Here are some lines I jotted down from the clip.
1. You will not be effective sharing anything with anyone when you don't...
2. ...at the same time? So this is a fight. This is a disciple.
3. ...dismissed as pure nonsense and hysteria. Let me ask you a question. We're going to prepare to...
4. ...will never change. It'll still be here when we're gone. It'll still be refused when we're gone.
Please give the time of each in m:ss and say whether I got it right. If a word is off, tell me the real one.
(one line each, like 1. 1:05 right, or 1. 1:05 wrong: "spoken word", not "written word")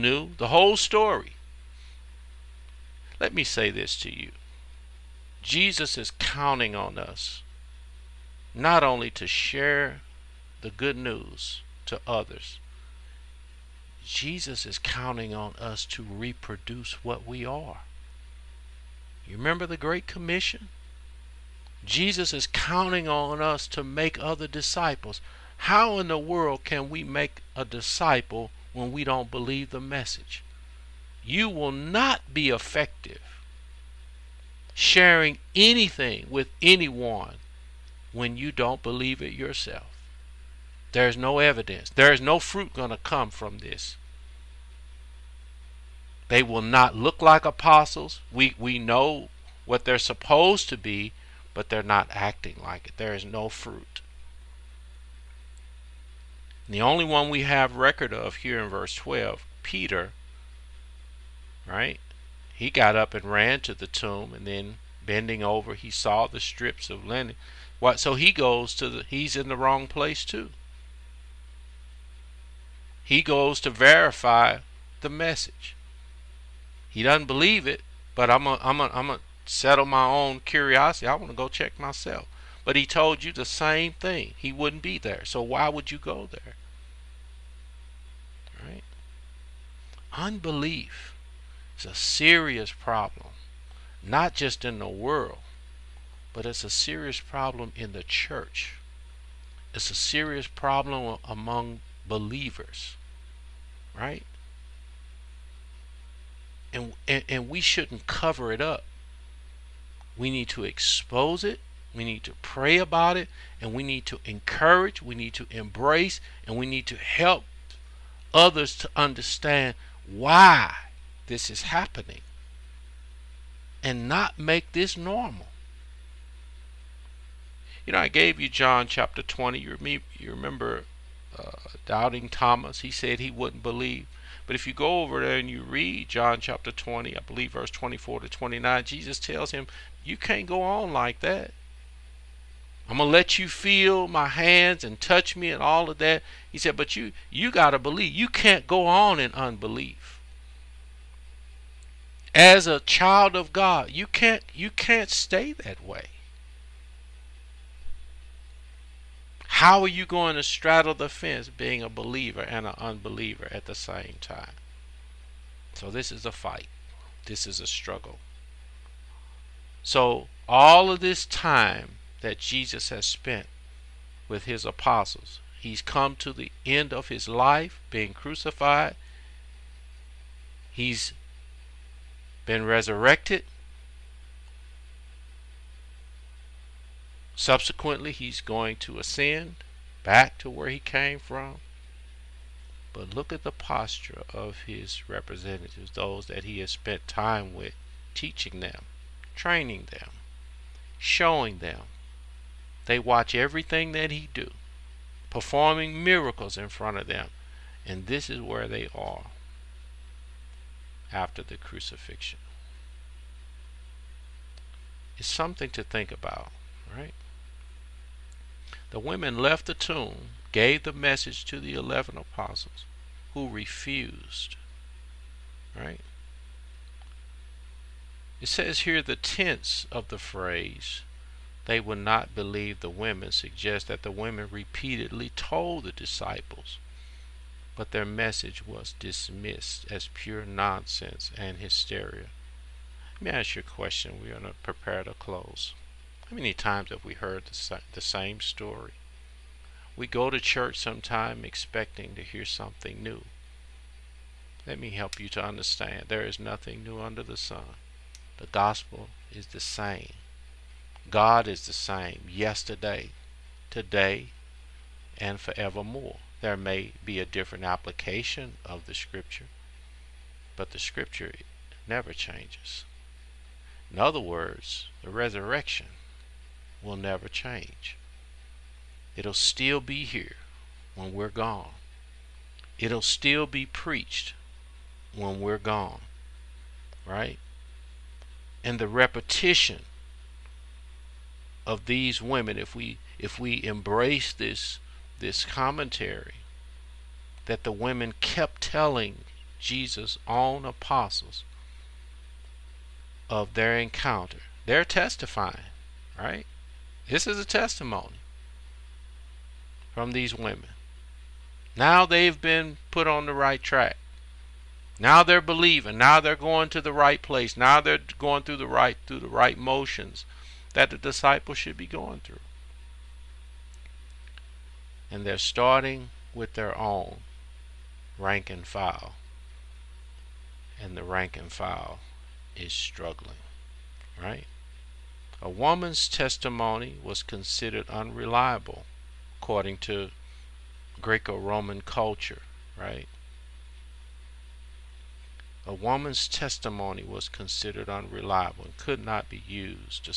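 1. 0:31 right
2. 2:43 wrong: "struggle", not "disciple"
3. 3:58 right
4. 4:36 wrong: "preached", not "refused".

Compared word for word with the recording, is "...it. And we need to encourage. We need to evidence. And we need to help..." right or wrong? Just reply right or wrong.
wrong.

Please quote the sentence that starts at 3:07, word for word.
Subsequently, he's going to ascend back to where he came from.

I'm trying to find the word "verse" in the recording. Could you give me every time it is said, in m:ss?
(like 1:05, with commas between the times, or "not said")
0:58, 2:17.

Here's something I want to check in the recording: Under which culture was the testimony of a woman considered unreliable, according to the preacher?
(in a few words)
Greco Roman.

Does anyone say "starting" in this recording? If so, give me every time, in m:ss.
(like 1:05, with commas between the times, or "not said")
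5:25.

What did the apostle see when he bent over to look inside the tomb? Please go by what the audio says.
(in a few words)
Strips of linen.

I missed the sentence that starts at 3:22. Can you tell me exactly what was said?
They watch everything that he do, performing miracles in front of them.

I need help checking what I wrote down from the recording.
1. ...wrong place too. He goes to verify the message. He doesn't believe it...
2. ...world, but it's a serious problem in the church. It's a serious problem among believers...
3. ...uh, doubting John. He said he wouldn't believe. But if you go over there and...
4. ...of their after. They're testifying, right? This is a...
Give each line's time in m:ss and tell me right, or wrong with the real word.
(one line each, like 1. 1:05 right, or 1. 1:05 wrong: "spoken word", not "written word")
1. 1:09 right
2. 1:34 right
3. 2:11 wrong: "Thomas", not "John"
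4. 5:03 wrong: "encounter", not "after".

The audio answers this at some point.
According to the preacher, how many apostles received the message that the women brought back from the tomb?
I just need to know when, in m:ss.
3:41.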